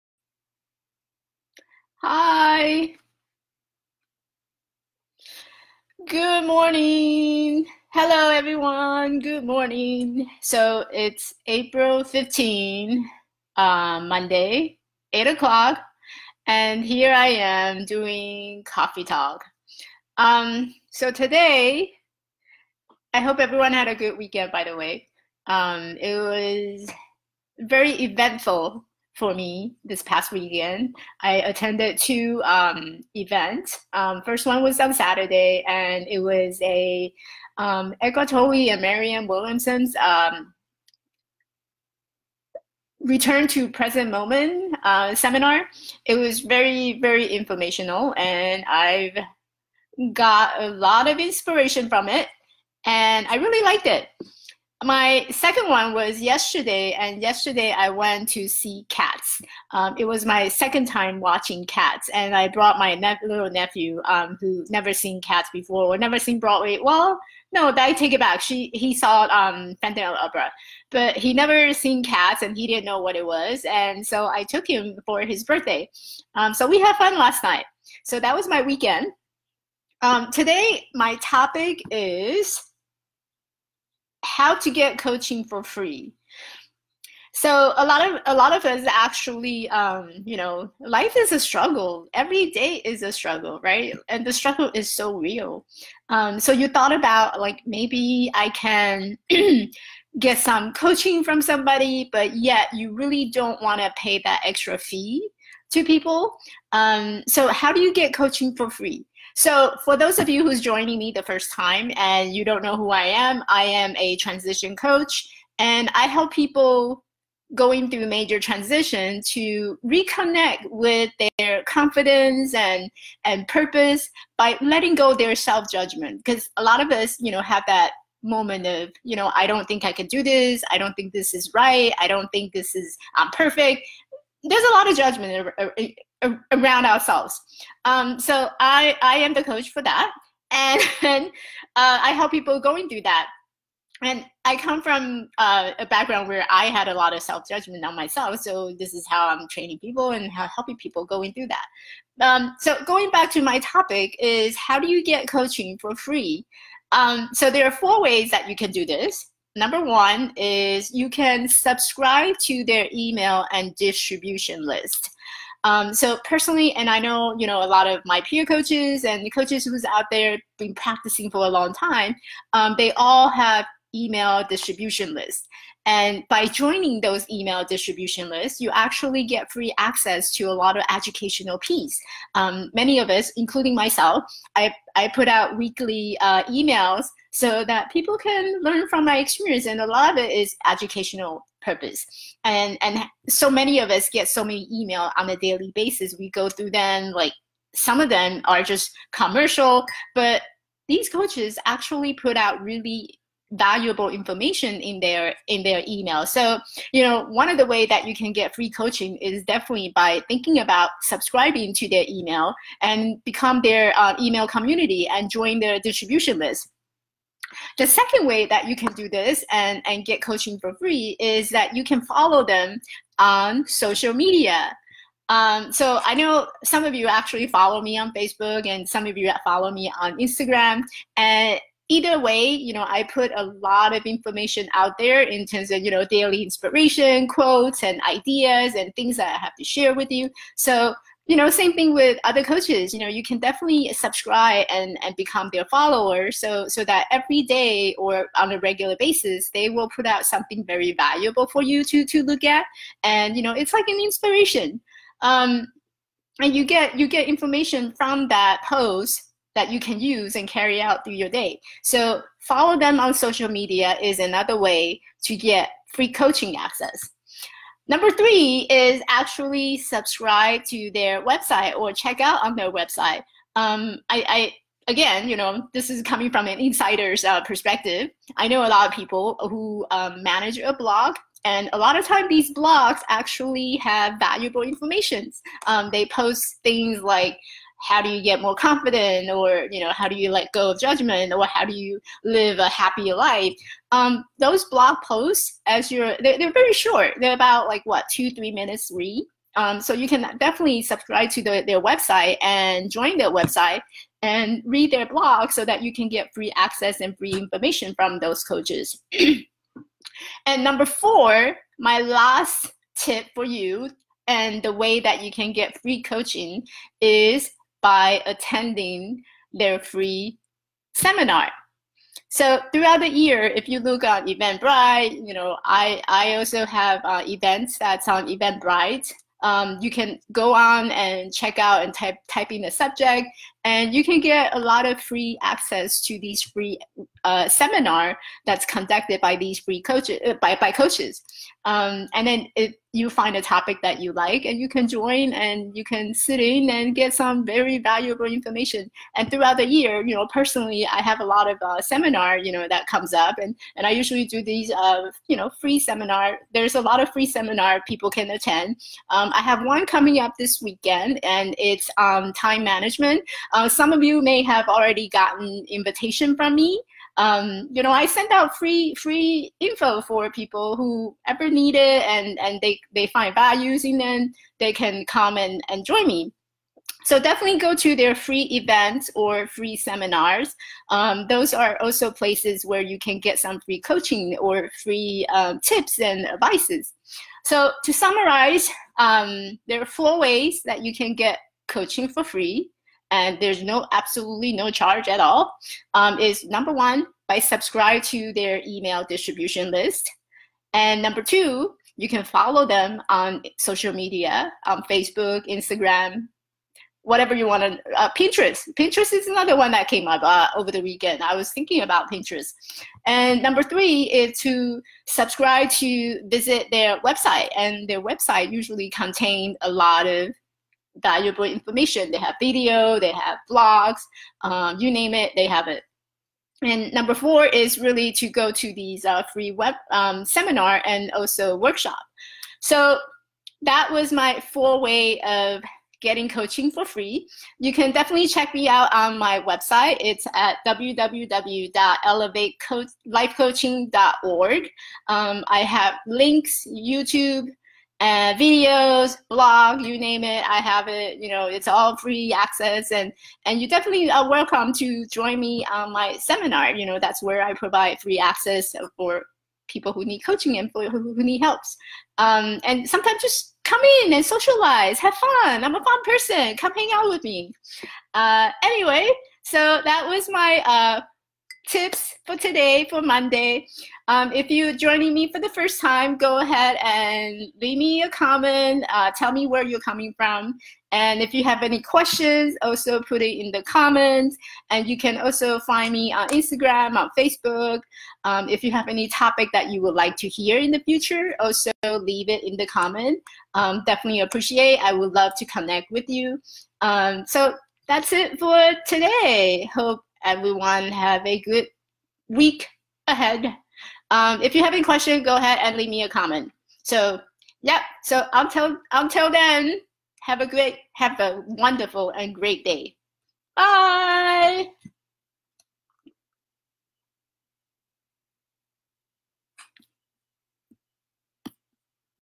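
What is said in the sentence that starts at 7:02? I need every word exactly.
They have video, they have blogs, um, you name it, they have it.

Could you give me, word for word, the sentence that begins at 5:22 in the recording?
So throughout the year, if you look on Eventbrite, you know, I, I also have uh, events that's on Eventbrite.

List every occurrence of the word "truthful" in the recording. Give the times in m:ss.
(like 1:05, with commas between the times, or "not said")
not said.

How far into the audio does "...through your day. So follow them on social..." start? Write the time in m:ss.
4:21.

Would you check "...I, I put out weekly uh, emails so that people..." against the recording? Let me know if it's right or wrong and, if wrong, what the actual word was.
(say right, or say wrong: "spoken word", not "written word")
right.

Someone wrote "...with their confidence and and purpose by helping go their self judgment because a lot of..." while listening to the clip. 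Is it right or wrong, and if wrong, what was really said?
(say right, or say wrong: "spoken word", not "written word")
wrong: "letting", not "helping".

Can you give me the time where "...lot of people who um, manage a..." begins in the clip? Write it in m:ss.
4:38.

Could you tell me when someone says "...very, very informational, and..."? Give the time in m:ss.
0:46.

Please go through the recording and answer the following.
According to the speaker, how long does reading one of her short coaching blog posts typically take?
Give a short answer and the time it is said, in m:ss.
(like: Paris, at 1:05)
2 to 3 minutes, at 4:58.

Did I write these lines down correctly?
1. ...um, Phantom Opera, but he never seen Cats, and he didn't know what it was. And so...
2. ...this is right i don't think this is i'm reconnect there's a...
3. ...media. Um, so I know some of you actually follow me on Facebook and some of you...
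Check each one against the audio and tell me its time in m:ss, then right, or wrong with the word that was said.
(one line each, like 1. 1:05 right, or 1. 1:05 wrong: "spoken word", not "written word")
1. 1:09 right
2. 2:11 wrong: "perfect", not "reconnect"
3. 3:44 right.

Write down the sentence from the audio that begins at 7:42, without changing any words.
Um, and sometimes just come in and socialize, have fun.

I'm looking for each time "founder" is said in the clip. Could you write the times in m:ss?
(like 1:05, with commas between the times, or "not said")
not said.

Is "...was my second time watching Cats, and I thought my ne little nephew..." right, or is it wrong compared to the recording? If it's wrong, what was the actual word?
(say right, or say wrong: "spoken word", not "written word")
wrong: "brought", not "thought".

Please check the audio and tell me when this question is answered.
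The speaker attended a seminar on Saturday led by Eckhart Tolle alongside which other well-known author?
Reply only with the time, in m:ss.
0:38.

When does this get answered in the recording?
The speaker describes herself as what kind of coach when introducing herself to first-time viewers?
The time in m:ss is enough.
1:54.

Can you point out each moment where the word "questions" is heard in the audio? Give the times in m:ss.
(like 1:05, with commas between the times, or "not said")
8:01, 8:24.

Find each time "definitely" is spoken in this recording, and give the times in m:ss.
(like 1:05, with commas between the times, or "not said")
3:29, 4:03, 5:00, 6:17, 7:17, 7:33, 8:13.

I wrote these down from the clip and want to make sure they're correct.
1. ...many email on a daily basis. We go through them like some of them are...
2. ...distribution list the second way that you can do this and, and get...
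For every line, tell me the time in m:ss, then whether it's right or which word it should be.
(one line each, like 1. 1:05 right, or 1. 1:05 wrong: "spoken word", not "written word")
1. 3:14 right
2. 3:35 right.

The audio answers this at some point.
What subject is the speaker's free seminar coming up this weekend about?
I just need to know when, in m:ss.
6:02.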